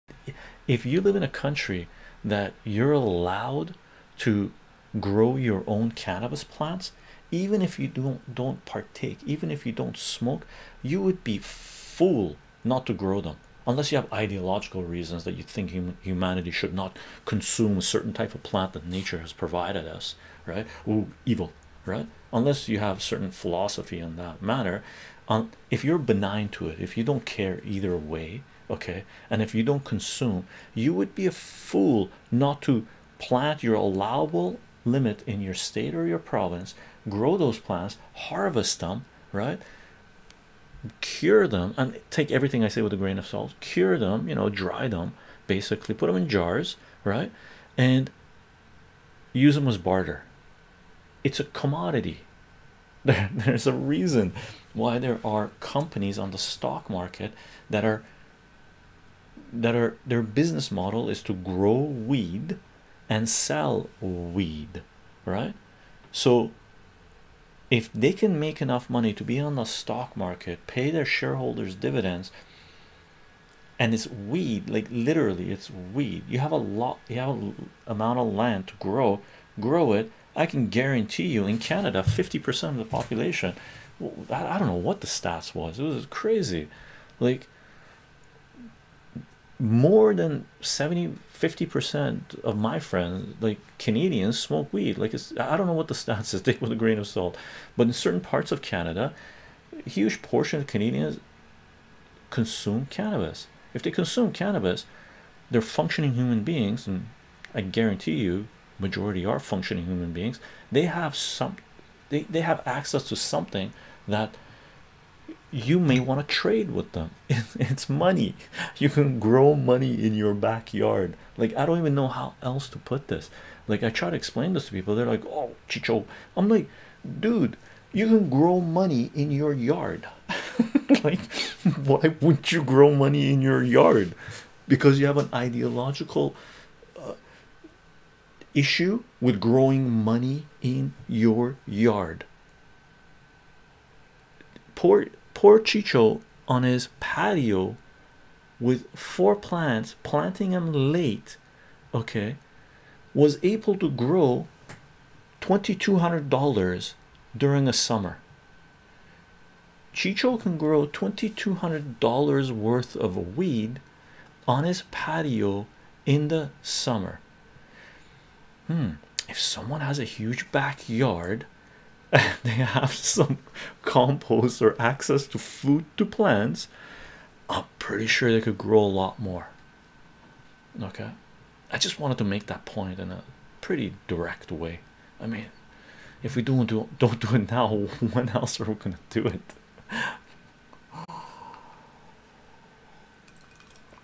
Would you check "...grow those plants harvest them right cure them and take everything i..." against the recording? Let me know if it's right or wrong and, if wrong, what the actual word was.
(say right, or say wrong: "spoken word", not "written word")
right.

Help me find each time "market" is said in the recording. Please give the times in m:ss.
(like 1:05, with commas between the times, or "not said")
0:56, 1:10.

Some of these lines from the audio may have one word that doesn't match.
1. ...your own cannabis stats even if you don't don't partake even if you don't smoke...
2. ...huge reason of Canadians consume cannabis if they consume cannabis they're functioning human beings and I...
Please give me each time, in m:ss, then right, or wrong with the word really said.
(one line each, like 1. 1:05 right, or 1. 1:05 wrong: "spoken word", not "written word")
1. 0:05 wrong: "plants", not "stats"
2. 1:39 wrong: "portion", not "reason".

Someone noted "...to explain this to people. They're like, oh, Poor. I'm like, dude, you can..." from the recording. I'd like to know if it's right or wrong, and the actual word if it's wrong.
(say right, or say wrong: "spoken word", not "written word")
wrong: "Chycho", not "Poor".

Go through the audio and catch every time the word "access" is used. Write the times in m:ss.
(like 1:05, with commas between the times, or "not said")
1:52, 2:54.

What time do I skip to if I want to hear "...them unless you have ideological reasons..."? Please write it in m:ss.
0:13.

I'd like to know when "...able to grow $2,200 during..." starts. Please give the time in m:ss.
2:33.